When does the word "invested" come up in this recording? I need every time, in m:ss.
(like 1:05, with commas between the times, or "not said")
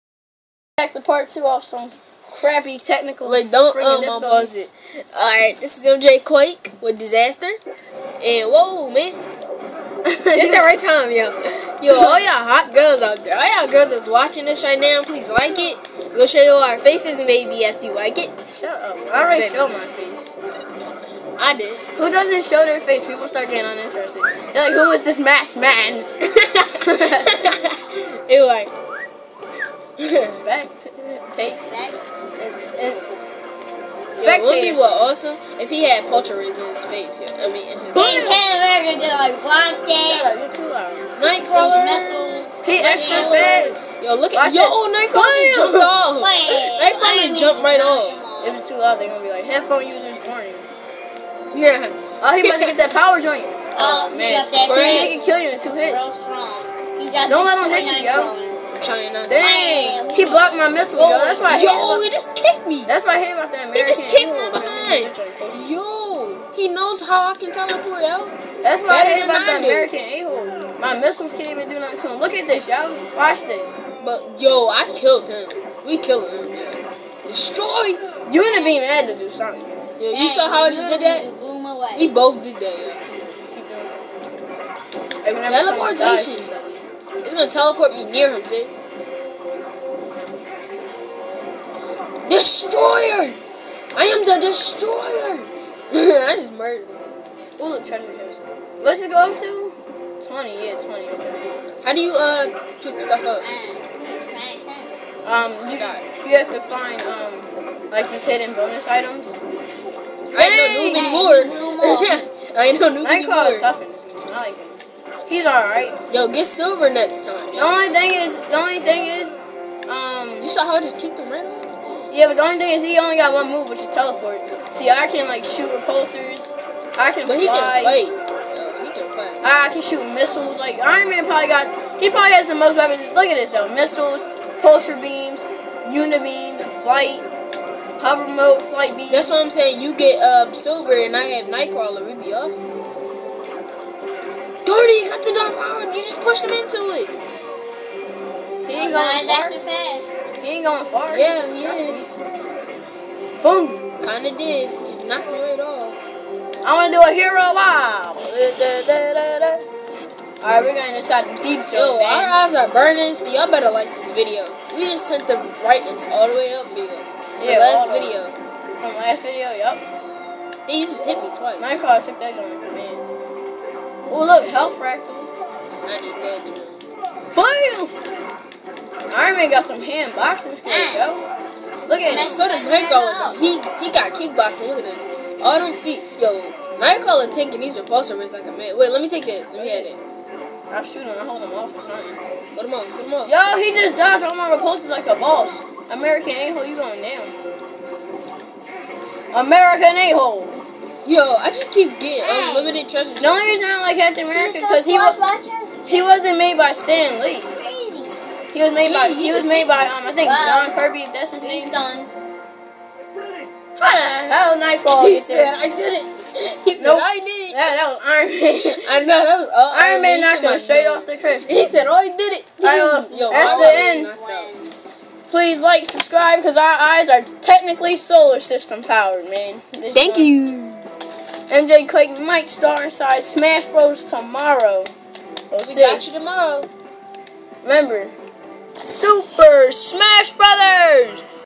not said.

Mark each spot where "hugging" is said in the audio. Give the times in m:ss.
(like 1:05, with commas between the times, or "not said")
not said.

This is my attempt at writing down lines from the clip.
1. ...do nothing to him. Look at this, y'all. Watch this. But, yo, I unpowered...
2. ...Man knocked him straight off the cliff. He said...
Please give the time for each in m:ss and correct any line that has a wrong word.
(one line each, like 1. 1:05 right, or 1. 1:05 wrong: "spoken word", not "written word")
1. 1:11 wrong: "killed", not "unpowered"
2. 3:40 right.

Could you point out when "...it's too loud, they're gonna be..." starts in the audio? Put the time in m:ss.
0:48.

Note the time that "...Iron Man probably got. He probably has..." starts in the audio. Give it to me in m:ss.
2:10.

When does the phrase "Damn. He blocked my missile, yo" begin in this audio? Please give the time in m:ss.
1:00.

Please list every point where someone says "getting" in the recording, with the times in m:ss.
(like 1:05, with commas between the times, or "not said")
0:23, 3:21.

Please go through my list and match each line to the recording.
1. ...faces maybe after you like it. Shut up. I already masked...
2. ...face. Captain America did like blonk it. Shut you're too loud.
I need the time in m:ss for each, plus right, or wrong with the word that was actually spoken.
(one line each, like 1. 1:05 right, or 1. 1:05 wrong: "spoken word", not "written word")
1. 0:16 wrong: "showed", not "masked"
2. 0:37 right.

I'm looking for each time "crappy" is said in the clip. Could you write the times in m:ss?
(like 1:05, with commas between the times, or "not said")
0:02.